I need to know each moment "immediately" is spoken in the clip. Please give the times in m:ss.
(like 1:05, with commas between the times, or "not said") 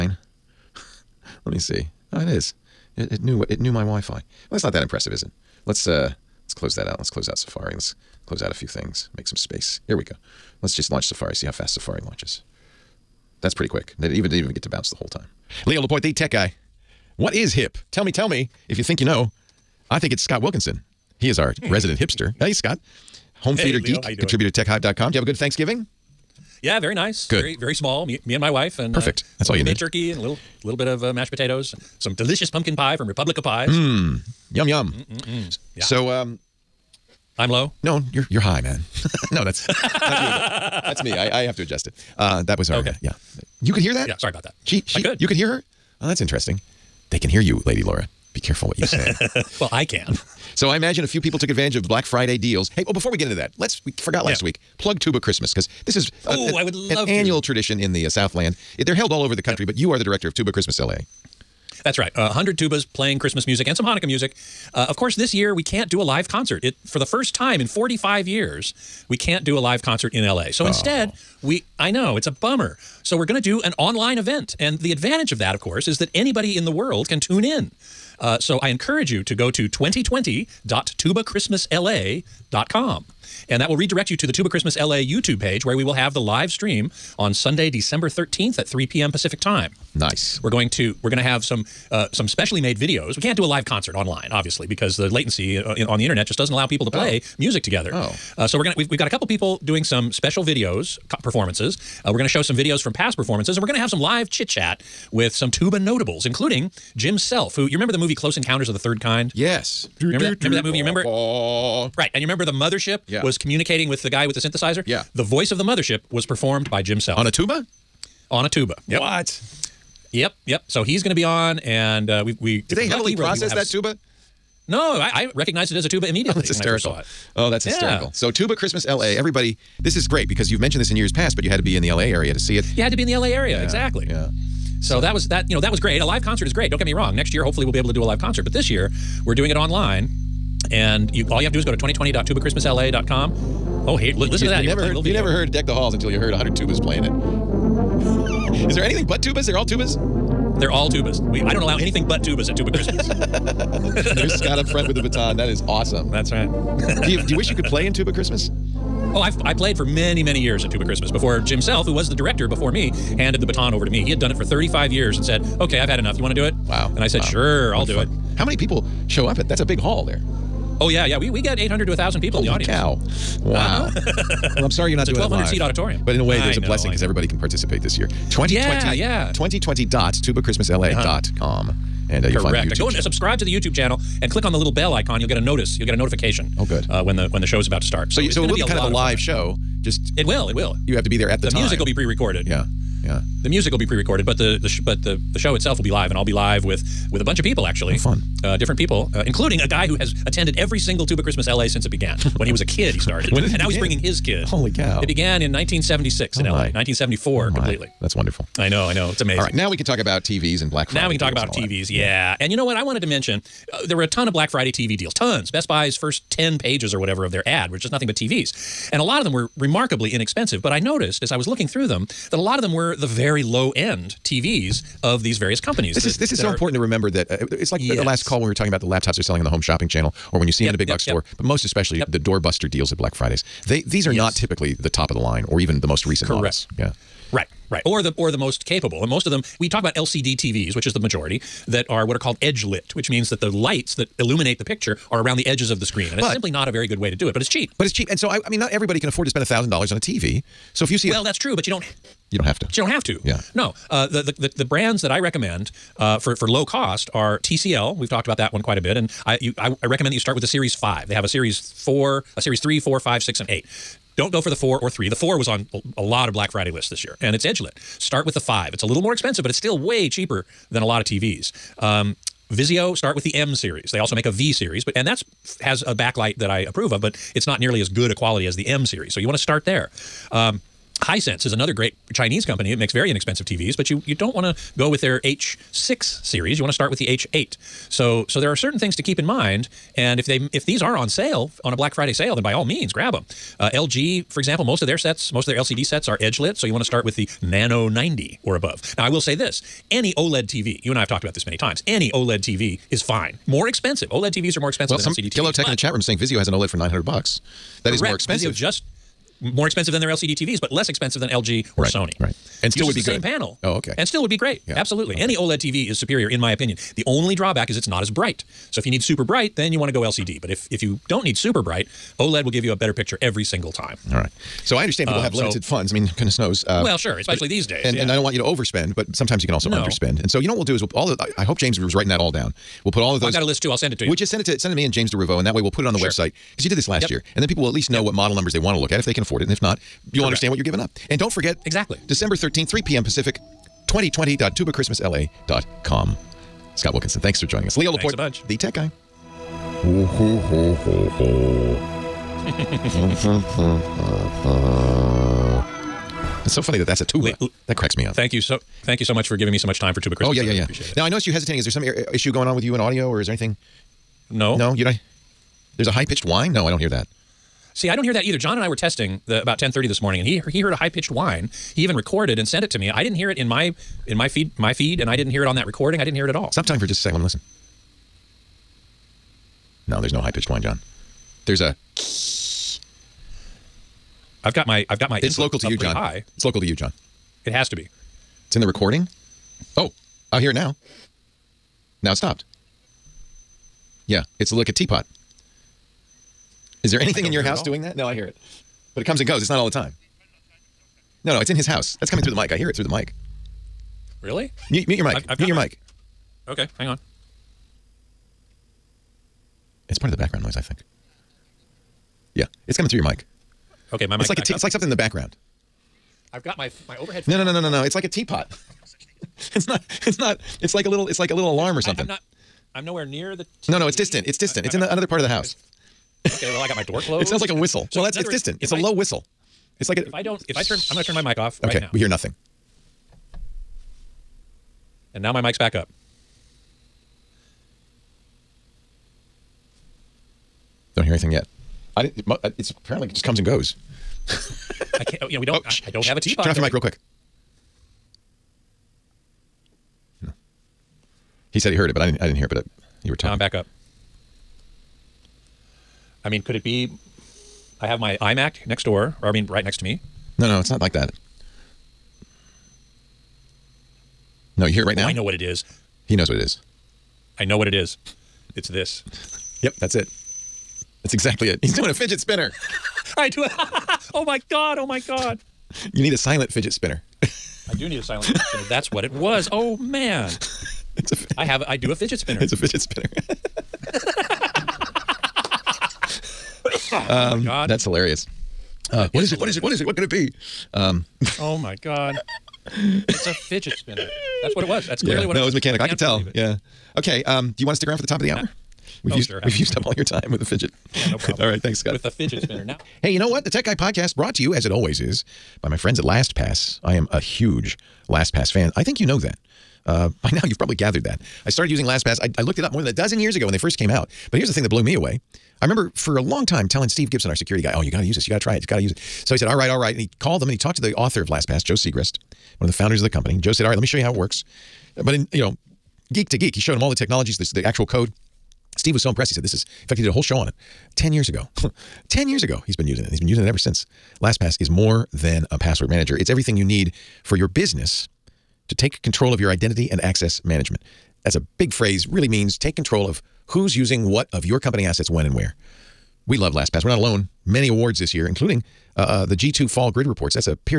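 2:06.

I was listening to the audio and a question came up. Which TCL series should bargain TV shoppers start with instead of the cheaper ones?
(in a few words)
Series 5.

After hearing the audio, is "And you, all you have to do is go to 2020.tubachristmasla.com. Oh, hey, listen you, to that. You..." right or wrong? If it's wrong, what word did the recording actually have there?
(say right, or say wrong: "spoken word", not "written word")
right.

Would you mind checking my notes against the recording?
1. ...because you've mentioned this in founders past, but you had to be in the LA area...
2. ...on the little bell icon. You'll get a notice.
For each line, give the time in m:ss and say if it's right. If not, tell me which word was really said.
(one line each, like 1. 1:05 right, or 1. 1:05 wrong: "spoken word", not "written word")
1. 2:10 wrong: "years", not "founders"
2. 3:04 right.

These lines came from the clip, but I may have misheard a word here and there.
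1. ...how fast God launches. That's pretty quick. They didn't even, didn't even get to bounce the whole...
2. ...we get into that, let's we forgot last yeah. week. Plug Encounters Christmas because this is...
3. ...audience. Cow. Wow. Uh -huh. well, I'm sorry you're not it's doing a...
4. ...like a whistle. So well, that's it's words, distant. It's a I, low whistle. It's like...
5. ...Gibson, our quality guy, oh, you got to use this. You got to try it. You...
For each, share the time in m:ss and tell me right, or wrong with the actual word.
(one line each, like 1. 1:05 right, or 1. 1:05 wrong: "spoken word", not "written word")
1. 0:11 wrong: "Safari", not "God"
2. 0:53 wrong: "Tuba", not "Encounters"
3. 2:52 right
4. 7:07 right
5. 8:37 wrong: "security", not "quality".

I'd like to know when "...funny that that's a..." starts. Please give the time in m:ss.
5:56.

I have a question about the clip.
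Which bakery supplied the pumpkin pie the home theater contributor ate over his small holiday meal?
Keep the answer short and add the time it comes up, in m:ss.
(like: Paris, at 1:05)
Republic of Pies, at 0:33.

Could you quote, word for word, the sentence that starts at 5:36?
website because you did this last yep.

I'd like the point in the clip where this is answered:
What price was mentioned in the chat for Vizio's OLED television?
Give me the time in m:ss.
5:06.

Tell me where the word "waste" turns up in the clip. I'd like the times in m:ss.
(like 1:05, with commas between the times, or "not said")
not said.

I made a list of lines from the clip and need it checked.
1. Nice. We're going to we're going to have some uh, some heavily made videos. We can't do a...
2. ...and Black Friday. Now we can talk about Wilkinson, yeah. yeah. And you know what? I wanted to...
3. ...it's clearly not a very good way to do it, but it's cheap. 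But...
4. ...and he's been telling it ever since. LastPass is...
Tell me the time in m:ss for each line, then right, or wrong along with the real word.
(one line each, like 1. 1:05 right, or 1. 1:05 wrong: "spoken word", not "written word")
1. 1:29 wrong: "specially", not "heavily"
2. 3:30 wrong: "TVs", not "Wilkinson"
3. 4:06 wrong: "simply", not "clearly"
4. 8:53 wrong: "using", not "telling".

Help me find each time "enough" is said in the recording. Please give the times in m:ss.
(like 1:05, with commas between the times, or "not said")
2:45.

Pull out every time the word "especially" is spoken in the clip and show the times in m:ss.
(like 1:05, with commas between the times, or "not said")
3:51, 5:27.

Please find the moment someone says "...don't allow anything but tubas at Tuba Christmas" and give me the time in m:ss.
2:31.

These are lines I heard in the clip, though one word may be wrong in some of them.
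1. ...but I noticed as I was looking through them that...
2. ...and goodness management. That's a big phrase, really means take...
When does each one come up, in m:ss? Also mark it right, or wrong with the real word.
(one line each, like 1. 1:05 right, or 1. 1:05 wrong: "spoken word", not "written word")
1. 3:40 right
2. 8:59 wrong: "access", not "goodness".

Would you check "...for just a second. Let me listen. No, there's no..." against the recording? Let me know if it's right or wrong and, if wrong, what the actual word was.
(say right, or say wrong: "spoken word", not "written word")
right.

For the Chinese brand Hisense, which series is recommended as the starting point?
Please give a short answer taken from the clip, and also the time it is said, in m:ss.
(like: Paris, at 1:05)
H8, at 4:47.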